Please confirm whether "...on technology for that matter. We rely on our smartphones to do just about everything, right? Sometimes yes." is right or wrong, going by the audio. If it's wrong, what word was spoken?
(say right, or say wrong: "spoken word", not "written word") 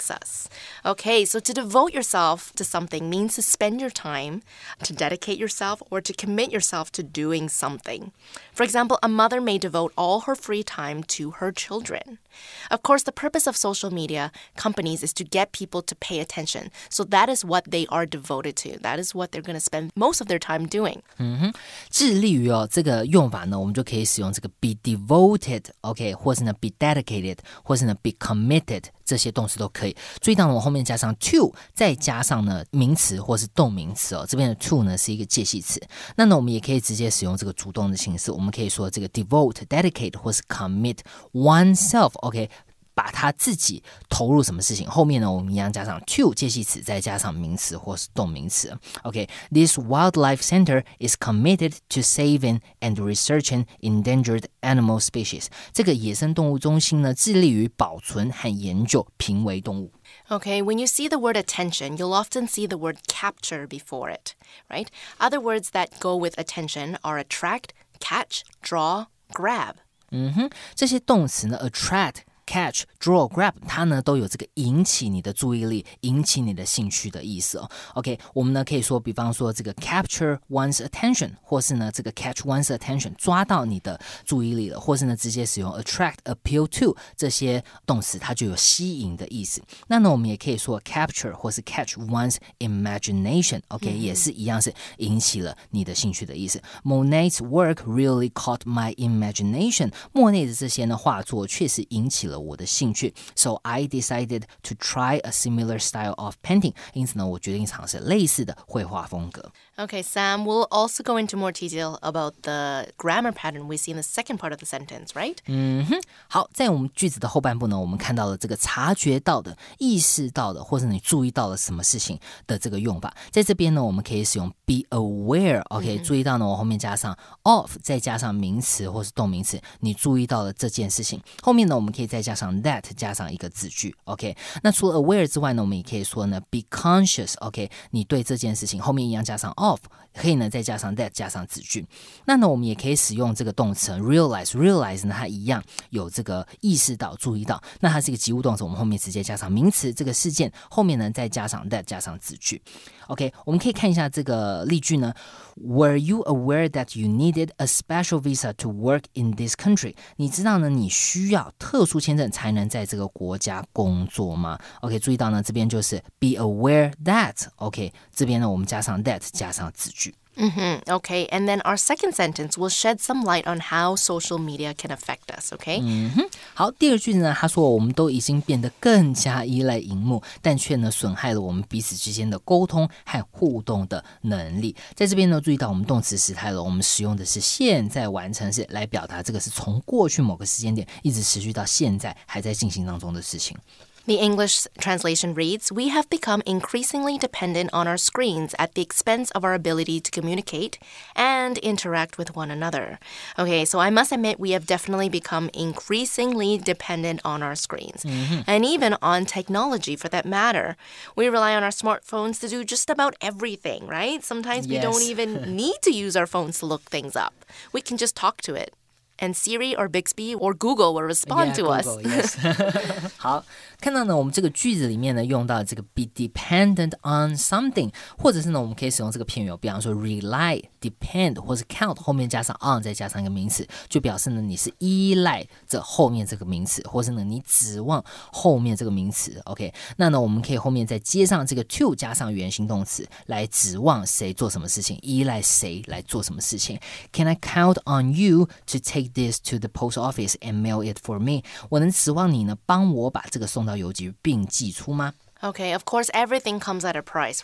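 right.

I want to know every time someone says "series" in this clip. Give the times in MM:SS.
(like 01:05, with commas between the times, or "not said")
not said.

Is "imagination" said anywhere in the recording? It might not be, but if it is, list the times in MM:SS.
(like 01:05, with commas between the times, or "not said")
01:32, 01:38.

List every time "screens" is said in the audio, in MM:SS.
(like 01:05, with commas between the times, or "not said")
03:17, 03:27.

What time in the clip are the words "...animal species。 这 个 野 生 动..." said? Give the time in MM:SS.
00:54.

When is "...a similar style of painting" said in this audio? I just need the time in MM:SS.
01:45.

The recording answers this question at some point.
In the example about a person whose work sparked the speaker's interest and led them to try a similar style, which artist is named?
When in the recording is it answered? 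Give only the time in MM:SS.
01:36.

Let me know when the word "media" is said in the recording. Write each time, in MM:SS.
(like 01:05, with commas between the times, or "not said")
00:13, 02:54.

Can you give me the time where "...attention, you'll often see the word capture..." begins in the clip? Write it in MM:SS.
01:01.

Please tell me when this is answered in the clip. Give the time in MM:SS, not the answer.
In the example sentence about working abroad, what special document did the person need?
02:37.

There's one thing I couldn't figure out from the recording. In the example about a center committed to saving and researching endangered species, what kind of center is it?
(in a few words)
wildlife center.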